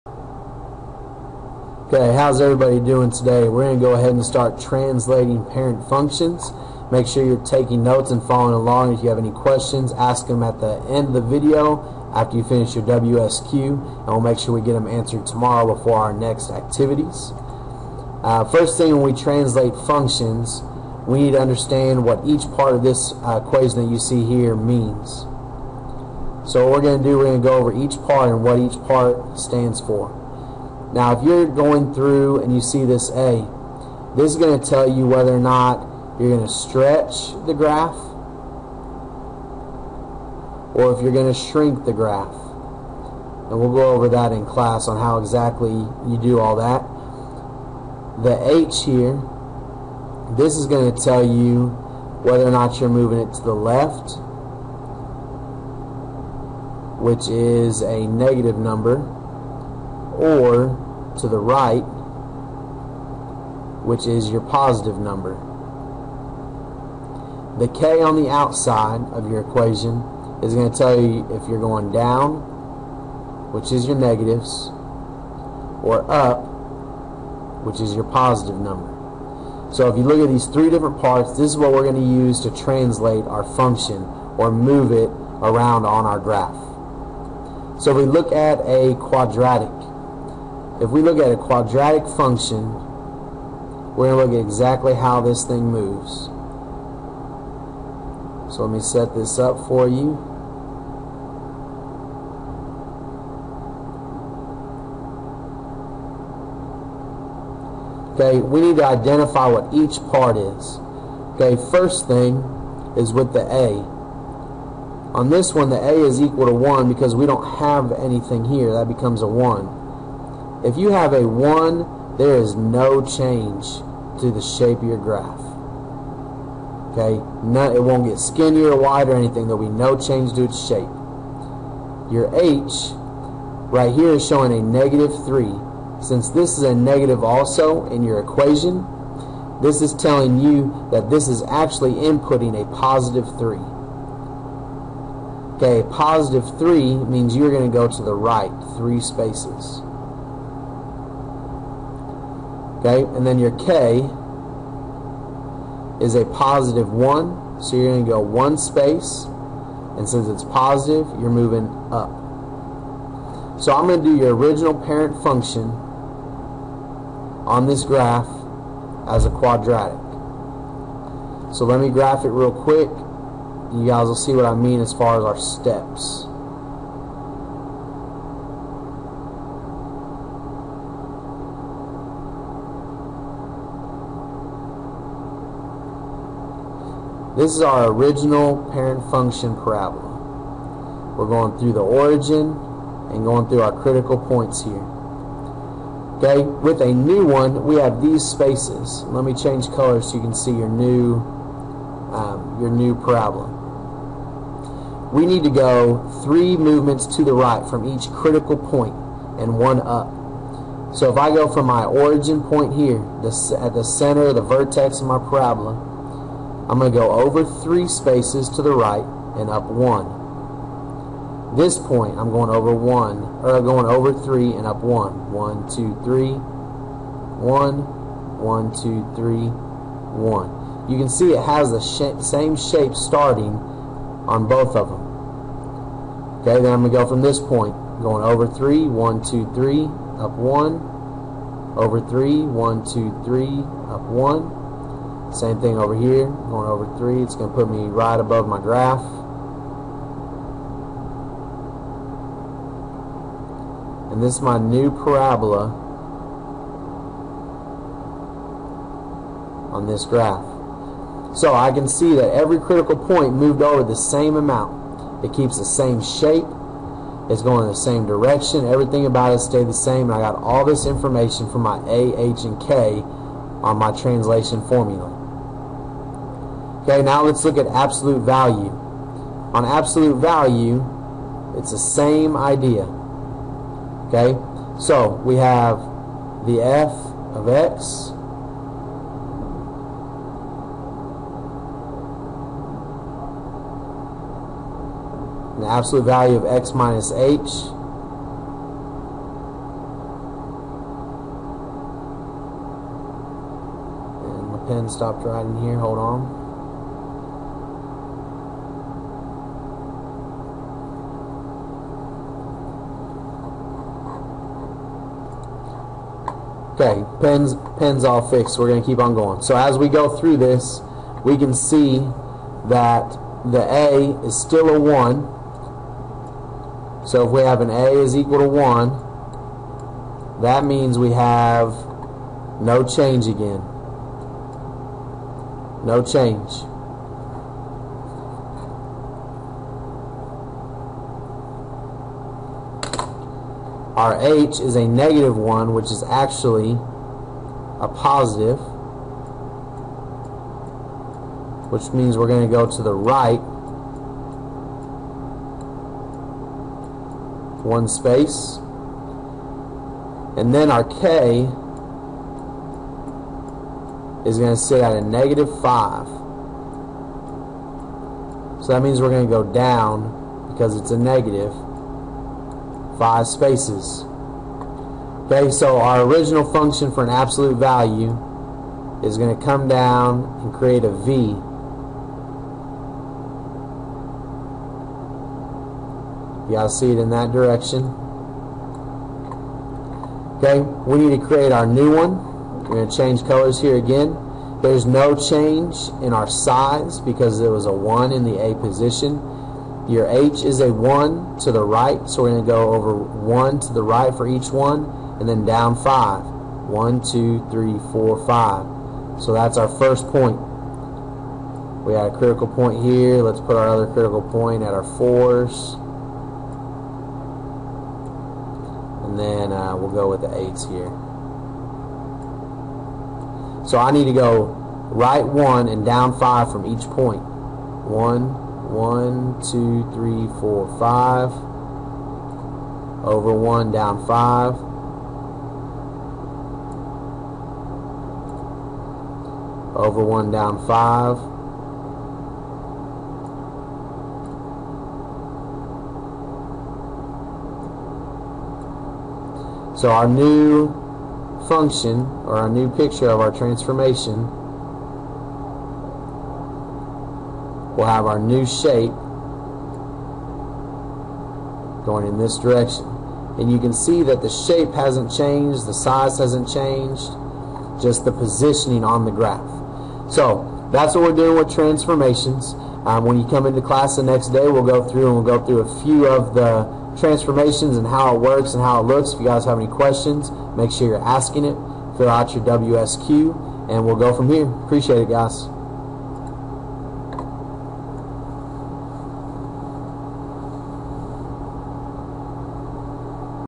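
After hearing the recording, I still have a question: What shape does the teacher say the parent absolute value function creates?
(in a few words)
A V.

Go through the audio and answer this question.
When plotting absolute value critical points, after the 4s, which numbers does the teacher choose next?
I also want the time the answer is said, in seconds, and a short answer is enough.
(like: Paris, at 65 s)
8s, at 420 s.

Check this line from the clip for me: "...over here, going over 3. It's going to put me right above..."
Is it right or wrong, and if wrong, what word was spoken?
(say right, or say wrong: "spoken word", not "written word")
right.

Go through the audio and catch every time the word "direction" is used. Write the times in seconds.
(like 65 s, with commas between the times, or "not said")
268 s, 387 s, 462 s.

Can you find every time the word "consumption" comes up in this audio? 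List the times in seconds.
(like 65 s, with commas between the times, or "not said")
not said.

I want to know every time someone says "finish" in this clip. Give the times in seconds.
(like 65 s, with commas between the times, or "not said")
12 s.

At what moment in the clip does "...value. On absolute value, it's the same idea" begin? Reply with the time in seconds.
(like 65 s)
278 s.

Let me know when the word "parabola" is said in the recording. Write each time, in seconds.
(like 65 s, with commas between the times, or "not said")
189 s, 202 s, 215 s, 254 s.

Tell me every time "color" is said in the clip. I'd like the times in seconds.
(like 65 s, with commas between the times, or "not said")
199 s, 393 s.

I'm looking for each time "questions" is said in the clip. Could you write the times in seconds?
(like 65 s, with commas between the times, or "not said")
9 s, 479 s.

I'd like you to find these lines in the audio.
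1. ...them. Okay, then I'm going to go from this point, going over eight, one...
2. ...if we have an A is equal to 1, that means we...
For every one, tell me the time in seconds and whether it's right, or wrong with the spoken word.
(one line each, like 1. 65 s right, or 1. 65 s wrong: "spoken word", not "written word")
1. 234 s wrong: "three", not "eight"
2. 327 s right.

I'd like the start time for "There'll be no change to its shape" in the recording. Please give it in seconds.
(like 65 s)
129 s.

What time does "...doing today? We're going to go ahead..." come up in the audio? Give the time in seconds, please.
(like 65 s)
2 s.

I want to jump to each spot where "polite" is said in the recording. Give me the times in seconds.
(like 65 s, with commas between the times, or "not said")
not said.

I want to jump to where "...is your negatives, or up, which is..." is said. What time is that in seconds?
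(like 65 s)
73 s.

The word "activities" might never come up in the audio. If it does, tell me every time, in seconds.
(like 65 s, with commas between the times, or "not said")
16 s.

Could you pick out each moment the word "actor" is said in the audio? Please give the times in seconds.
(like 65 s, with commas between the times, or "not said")
not said.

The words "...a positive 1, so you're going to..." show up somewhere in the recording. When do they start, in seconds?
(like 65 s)
156 s.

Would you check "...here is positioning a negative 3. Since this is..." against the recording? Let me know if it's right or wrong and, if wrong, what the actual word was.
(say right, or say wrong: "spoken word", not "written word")
wrong: "showing", not "positioning".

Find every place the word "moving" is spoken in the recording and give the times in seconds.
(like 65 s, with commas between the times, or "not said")
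52 s, 161 s.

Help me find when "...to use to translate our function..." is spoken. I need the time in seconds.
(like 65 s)
81 s.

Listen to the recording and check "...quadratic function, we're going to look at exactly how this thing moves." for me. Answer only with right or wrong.
right.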